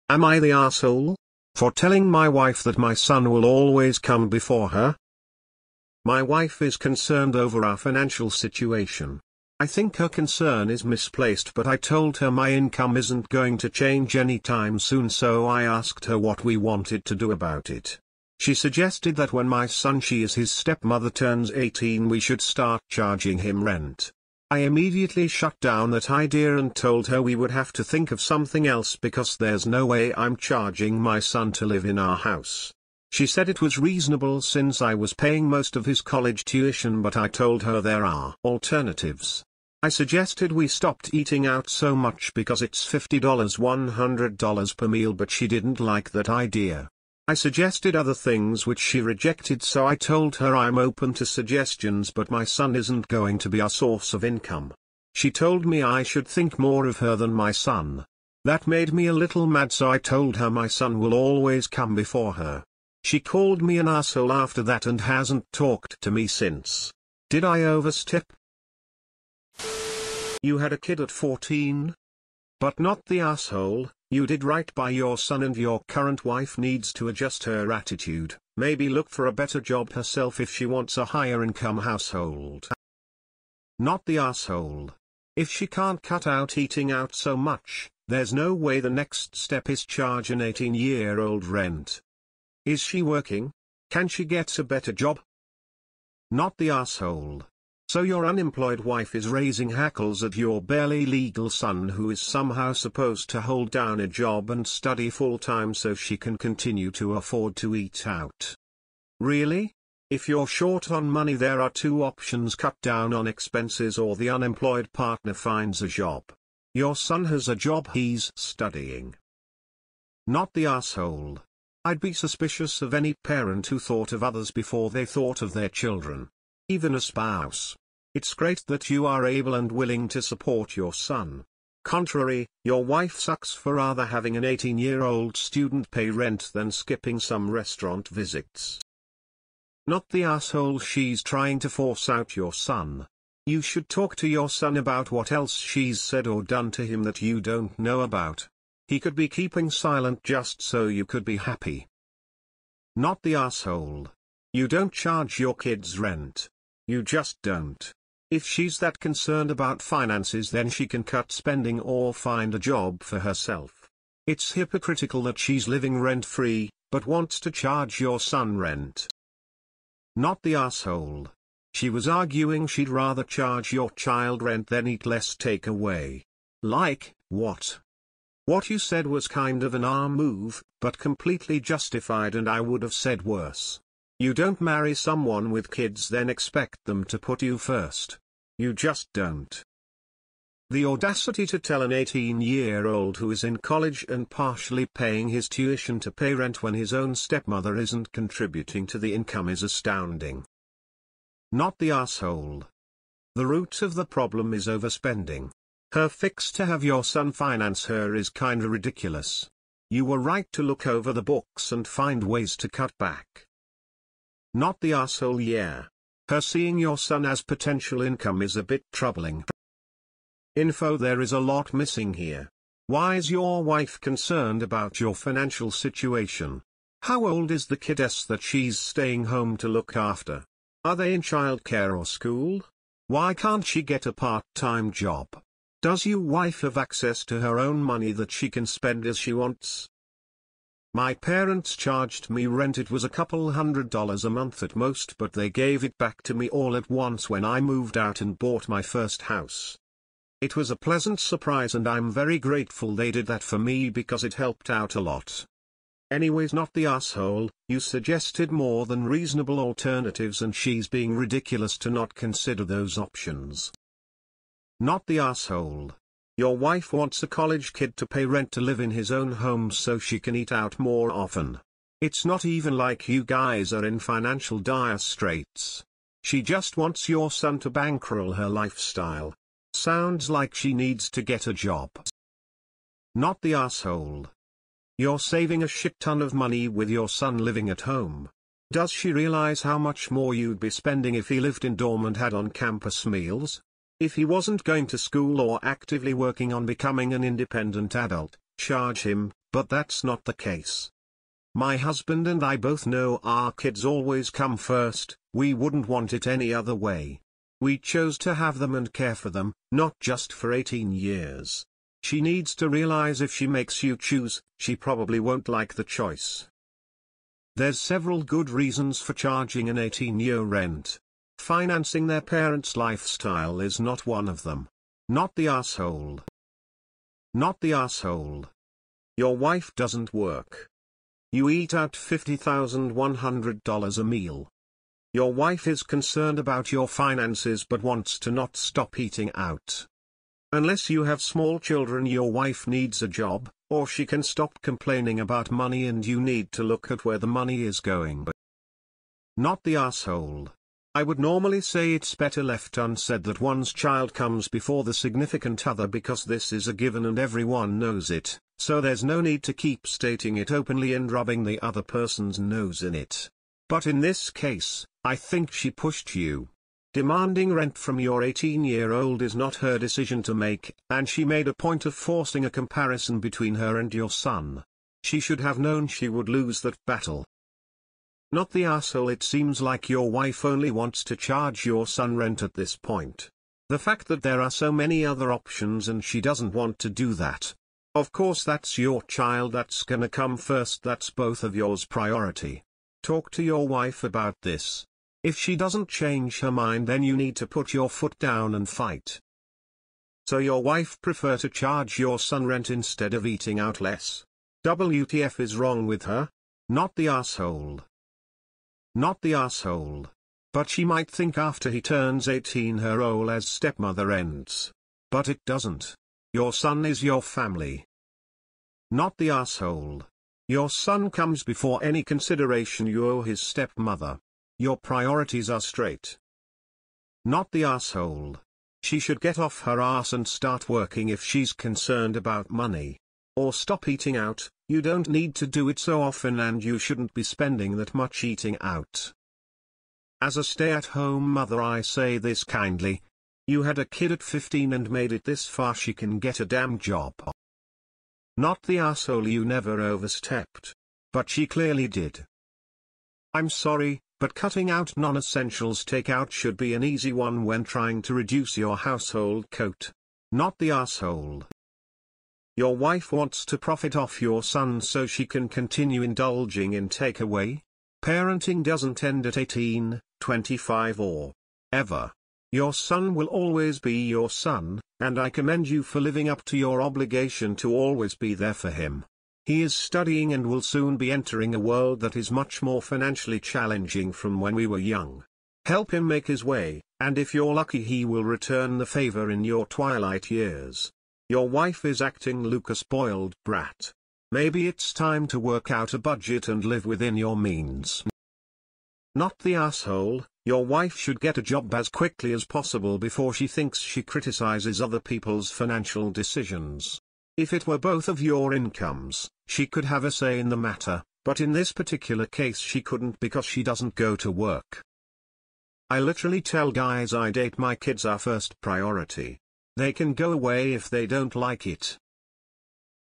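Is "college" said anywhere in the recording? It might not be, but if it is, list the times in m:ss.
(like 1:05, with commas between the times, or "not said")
0:36, 3:13, 4:27.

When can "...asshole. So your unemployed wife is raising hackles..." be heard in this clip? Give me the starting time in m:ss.
1:36.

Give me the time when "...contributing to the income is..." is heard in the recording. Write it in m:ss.
3:18.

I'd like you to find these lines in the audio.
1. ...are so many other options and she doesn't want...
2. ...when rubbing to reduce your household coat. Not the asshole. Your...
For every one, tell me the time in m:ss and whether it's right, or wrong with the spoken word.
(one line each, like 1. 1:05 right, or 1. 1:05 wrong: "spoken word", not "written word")
1. 6:24 right
2. 7:37 wrong: "trying", not "rubbing".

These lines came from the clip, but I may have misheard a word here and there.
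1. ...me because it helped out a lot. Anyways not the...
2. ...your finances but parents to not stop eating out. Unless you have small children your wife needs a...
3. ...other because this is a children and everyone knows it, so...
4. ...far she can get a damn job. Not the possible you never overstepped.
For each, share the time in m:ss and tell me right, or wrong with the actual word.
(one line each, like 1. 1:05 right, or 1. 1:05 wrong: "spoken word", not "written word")
1. 4:13 right
2. 5:36 wrong: "wants", not "parents"
3. 5:55 wrong: "given", not "children"
4. 7:25 wrong: "asshole", not "possible".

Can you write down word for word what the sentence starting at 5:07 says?
We chose to have them and care for them, not just for 18 years.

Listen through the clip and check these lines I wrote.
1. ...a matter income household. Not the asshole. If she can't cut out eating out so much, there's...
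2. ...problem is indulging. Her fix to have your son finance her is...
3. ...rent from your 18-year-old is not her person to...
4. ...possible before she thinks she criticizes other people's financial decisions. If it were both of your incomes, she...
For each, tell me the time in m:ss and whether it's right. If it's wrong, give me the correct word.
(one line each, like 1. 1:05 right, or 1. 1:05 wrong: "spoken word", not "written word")
1. 1:20 wrong: "higher", not "matter"
2. 3:24 wrong: "overspending", not "indulging"
3. 6:07 wrong: "decision", not "person"
4. 8:22 right.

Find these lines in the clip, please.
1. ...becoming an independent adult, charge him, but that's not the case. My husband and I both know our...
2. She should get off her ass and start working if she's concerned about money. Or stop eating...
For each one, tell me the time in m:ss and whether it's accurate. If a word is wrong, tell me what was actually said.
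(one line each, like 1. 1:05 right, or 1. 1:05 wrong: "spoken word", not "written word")
1. 4:56 right
2. 7:08 right.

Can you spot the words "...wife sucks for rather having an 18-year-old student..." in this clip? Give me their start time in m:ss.
2:12.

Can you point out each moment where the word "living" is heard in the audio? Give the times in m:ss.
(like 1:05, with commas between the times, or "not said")
2:45, 4:47, 7:55.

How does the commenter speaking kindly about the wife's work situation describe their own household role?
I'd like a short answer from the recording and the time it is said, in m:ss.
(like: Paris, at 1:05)
stay-at-home mother, at 7:20.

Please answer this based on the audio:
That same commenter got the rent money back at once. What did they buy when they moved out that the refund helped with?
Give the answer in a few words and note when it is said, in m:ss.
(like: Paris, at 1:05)
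first house, at 4:08.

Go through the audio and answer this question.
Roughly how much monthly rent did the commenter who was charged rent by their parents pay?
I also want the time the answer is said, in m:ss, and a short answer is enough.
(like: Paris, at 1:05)
a couple hundred dollars, at 4:03.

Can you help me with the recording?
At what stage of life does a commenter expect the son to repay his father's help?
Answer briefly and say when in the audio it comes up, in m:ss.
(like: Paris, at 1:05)
twilight years, at 8:09.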